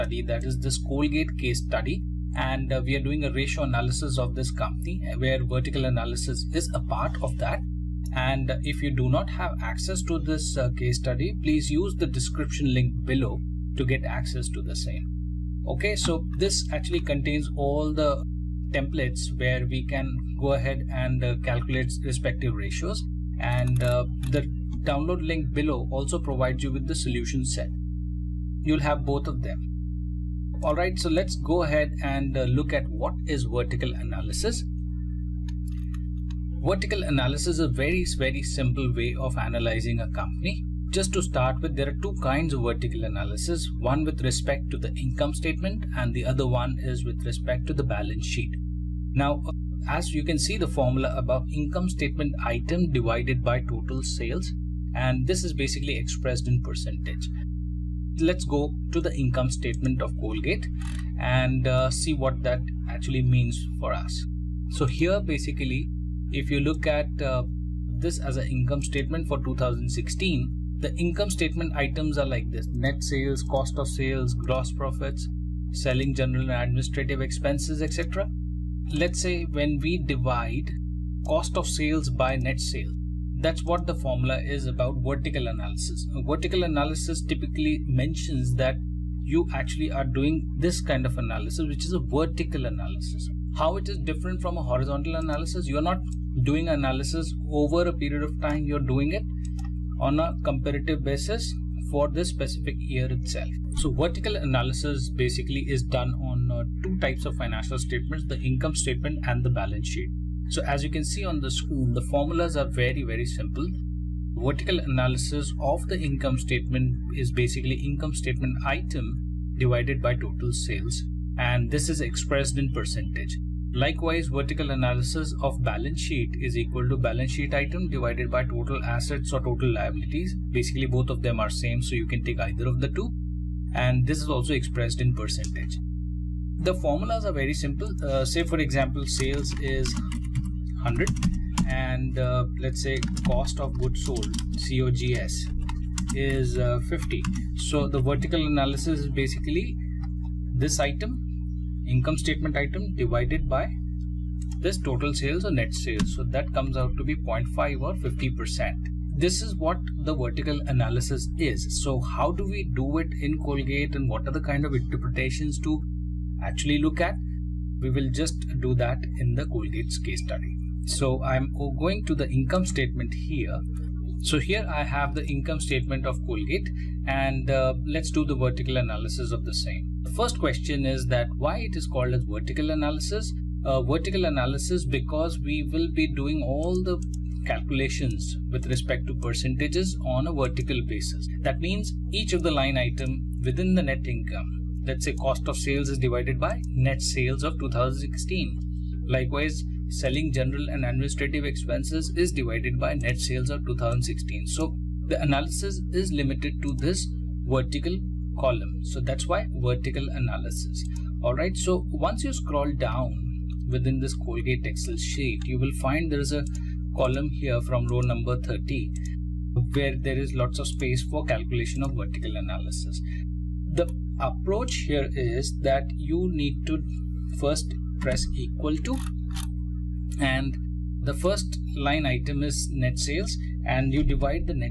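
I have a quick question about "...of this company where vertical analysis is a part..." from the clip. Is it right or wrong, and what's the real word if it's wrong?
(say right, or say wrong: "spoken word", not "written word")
right.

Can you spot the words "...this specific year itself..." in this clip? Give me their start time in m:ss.
1:42.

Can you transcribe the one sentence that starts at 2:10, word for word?
Basically, both of them are same, so you can take either of the two.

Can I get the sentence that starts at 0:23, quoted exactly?
And uh, the download link below also provides you with the solution set.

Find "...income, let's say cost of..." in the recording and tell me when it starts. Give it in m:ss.
3:14.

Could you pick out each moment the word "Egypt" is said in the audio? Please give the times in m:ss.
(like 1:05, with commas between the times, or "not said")
not said.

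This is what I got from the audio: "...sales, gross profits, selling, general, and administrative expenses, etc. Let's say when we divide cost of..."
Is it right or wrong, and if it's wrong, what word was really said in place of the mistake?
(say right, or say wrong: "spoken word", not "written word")
right.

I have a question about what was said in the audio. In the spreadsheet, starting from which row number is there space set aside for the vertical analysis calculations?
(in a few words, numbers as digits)
30.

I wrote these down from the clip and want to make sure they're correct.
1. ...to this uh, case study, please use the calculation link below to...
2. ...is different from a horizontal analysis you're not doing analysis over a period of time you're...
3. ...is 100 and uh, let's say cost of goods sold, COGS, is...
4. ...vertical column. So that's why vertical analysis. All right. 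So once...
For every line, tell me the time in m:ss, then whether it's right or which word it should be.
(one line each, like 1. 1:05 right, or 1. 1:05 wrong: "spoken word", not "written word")
1. 0:10 wrong: "description", not "calculation"
2. 1:33 right
3. 2:19 right
4. 3:27 right.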